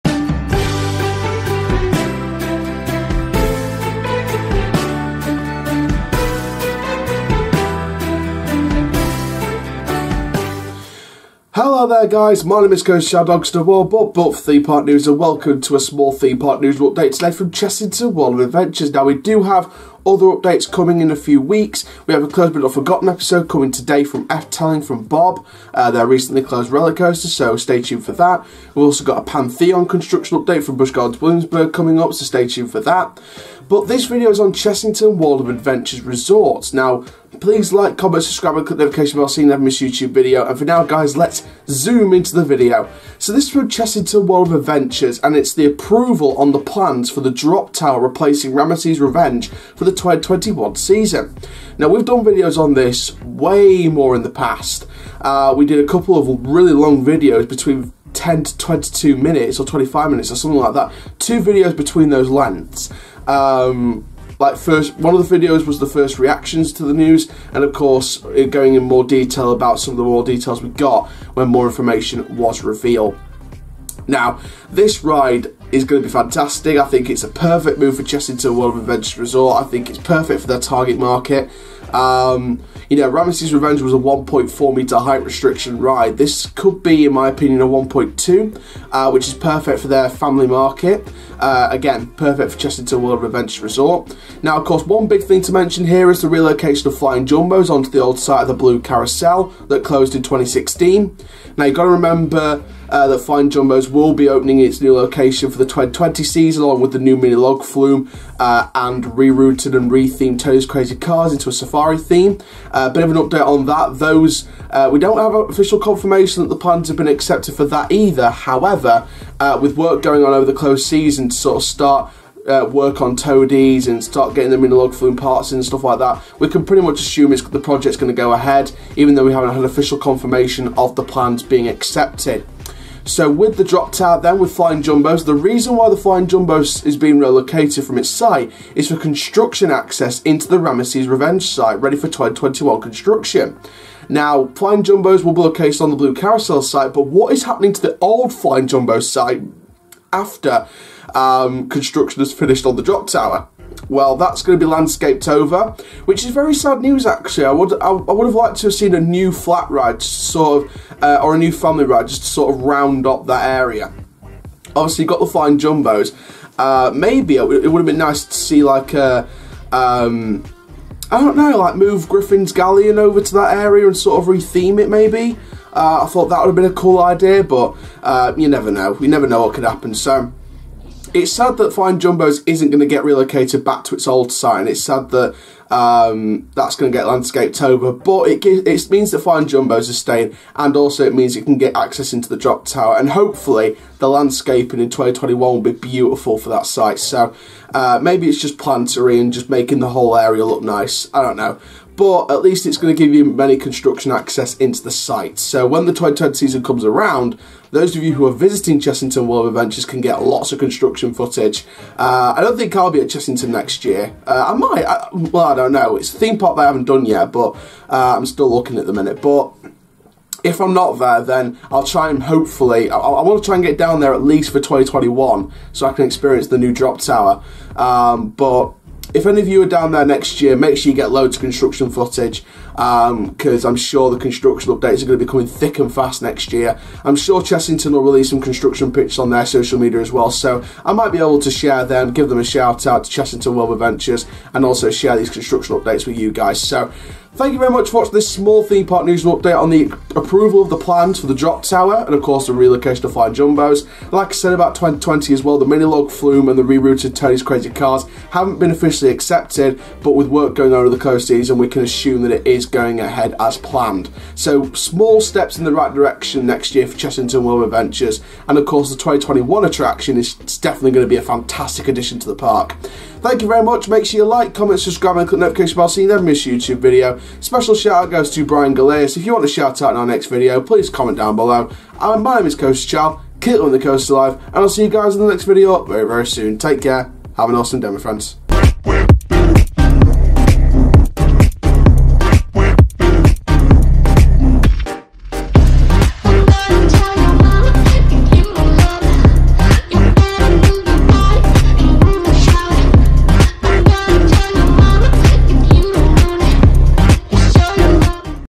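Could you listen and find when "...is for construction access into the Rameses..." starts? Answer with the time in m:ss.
2:18.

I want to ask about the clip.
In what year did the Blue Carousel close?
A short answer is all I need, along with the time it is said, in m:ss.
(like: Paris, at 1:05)
2016, at 1:40.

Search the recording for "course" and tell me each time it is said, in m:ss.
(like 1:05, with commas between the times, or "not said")
1:07, 1:34, 4:12, 4:28.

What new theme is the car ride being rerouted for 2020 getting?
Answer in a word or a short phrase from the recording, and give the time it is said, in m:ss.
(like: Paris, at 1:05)
safari, at 1:51.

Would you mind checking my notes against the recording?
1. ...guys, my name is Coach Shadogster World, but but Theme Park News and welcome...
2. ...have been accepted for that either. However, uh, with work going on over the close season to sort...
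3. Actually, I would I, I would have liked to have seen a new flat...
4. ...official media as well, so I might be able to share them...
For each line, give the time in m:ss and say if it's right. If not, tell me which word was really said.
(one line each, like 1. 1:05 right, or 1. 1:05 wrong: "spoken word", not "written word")
1. 0:12 right
2. 1:56 right
3. 2:37 right
4. 3:59 wrong: "social", not "official".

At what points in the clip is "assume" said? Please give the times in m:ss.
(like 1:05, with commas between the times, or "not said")
2:06, 4:21.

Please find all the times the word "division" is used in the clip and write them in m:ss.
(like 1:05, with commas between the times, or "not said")
not said.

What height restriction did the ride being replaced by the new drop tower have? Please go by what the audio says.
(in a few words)
1.4 meters.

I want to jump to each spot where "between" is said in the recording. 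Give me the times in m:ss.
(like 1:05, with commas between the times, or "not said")
0:57, 1:01.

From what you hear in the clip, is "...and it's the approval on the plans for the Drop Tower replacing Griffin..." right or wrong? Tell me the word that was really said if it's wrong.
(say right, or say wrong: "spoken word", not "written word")
wrong: "Rameses", not "Griffin".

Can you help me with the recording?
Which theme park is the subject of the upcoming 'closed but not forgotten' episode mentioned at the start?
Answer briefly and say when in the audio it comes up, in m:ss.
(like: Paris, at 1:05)
Efteling, at 0:24.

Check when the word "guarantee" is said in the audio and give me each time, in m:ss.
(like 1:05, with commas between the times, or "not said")
not said.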